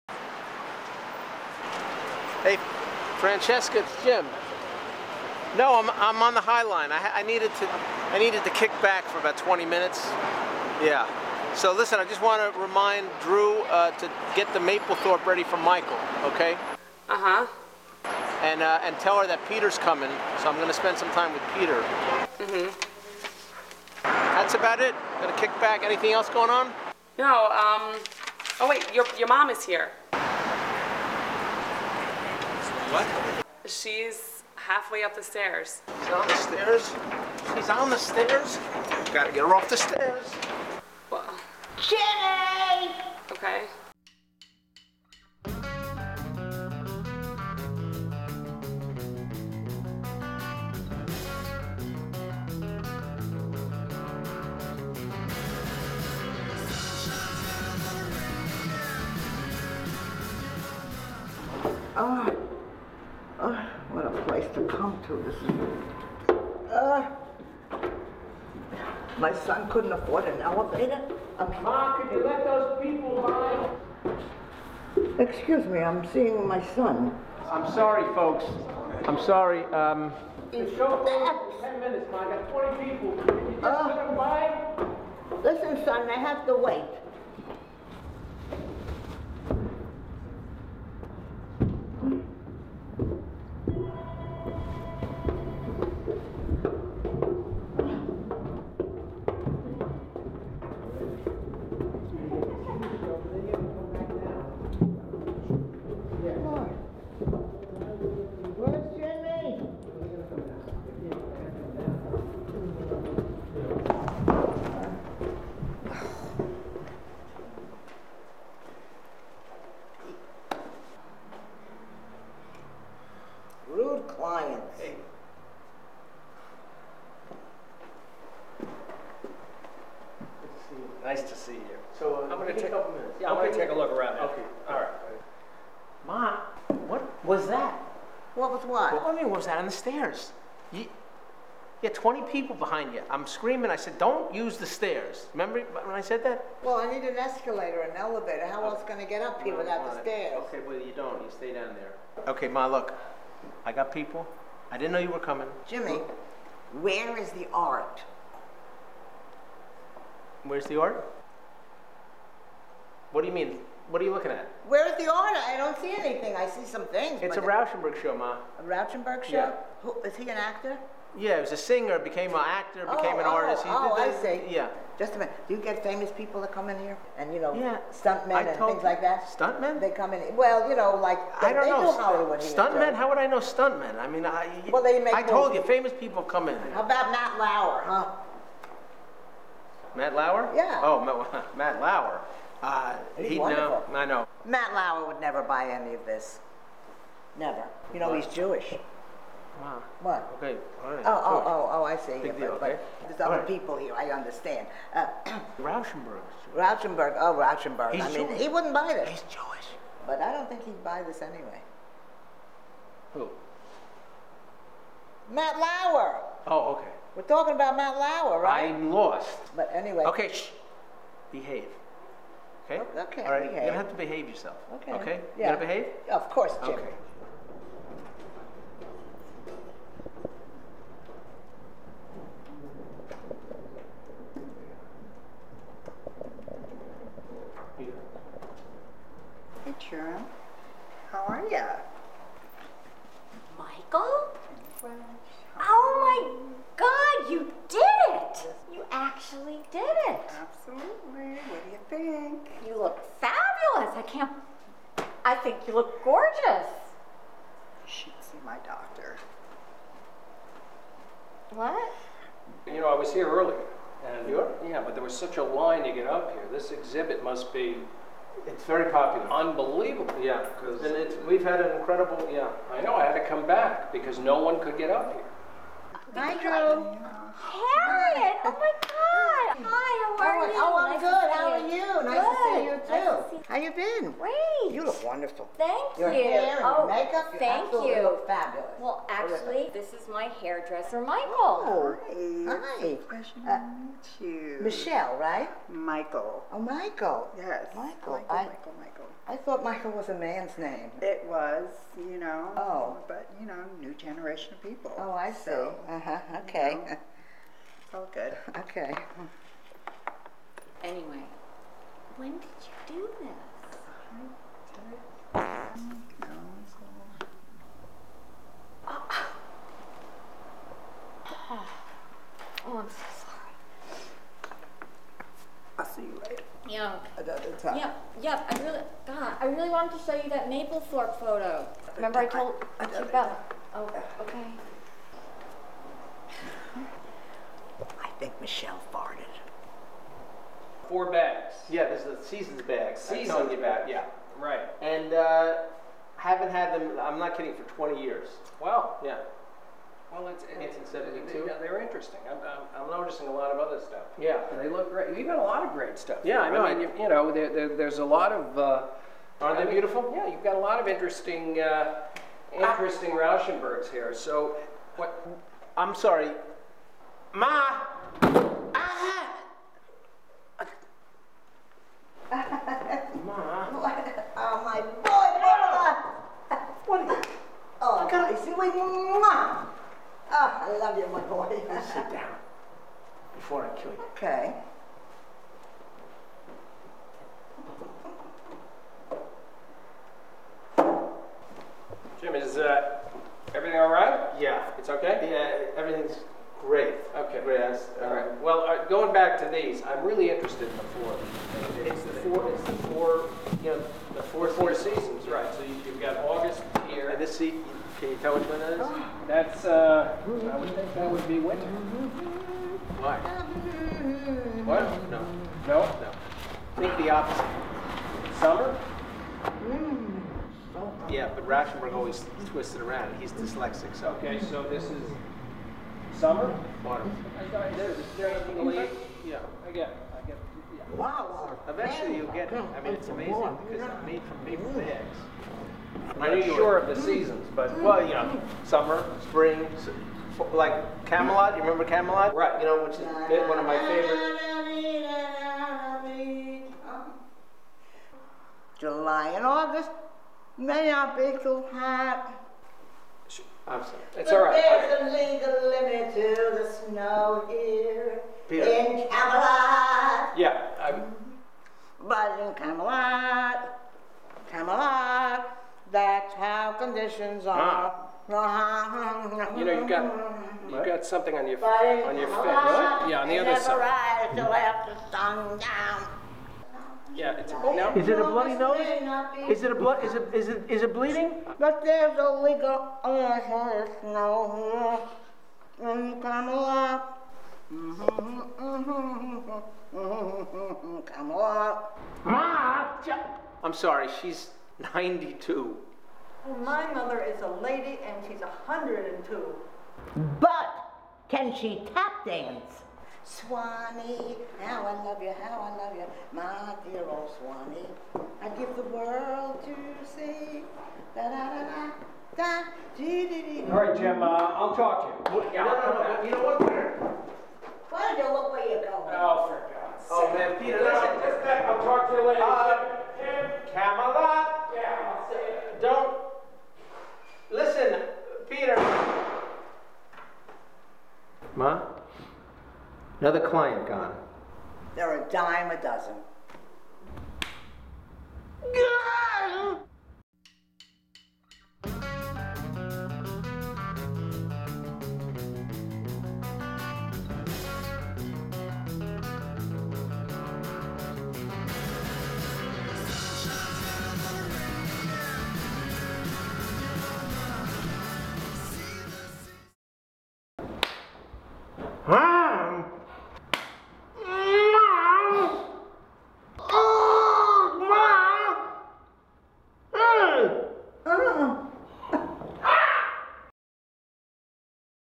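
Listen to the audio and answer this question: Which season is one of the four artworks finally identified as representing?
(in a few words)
Autumn.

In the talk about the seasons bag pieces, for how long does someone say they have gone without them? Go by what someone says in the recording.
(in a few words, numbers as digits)
20 years.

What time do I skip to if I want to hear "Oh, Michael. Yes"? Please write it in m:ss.
4:56.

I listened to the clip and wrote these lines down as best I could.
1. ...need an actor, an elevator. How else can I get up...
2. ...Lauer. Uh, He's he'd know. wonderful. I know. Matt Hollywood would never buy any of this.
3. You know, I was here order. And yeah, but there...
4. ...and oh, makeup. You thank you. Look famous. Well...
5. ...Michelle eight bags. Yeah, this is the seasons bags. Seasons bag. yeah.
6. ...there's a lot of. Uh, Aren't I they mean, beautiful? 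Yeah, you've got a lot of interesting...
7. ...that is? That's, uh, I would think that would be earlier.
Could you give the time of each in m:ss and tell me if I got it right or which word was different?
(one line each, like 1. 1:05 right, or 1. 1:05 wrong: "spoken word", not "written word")
1. 2:26 wrong: "escalator", not "actor"
2. 3:11 wrong: "Lauer", not "Hollywood"
3. 4:22 wrong: "earlier", not "order"
4. 4:46 wrong: "fabulous", not "famous"
5. 5:38 wrong: "four", not "eight"
6. 5:57 right
7. 6:48 wrong: "winter", not "earlier".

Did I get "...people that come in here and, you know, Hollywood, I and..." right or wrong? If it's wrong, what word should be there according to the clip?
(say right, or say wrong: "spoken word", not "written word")
wrong: "Yeah", not "Hollywood".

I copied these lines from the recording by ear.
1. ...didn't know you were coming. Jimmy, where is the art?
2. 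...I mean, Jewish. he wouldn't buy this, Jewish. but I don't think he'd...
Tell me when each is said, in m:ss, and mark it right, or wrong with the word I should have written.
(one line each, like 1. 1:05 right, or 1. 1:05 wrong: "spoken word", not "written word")
1. 2:34 right
2. 3:28 right.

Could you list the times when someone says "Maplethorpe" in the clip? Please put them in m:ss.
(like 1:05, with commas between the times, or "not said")
0:14, 5:30.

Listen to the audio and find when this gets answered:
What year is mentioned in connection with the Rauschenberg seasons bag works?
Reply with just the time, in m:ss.
5:50.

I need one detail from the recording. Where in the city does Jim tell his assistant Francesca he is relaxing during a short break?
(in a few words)
High Line.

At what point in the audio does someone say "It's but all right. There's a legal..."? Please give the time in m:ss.
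7:34.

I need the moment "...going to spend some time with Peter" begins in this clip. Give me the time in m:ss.
0:20.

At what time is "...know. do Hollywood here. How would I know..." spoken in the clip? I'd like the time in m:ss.
3:01.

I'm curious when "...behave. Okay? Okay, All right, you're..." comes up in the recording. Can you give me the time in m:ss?
3:41.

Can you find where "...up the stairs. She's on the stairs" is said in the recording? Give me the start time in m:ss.
0:35.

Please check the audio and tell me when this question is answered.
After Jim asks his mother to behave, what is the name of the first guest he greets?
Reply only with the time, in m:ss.
3:59.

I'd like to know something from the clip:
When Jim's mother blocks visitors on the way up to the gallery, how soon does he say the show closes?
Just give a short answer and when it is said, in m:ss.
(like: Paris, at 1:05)
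10 minutes, at 1:21.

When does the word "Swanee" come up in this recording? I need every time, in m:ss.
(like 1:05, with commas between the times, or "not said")
8:23, 8:27.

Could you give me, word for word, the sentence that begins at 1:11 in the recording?
I'm Ma, could you let those people by?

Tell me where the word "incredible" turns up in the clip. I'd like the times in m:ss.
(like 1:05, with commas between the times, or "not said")
4:31.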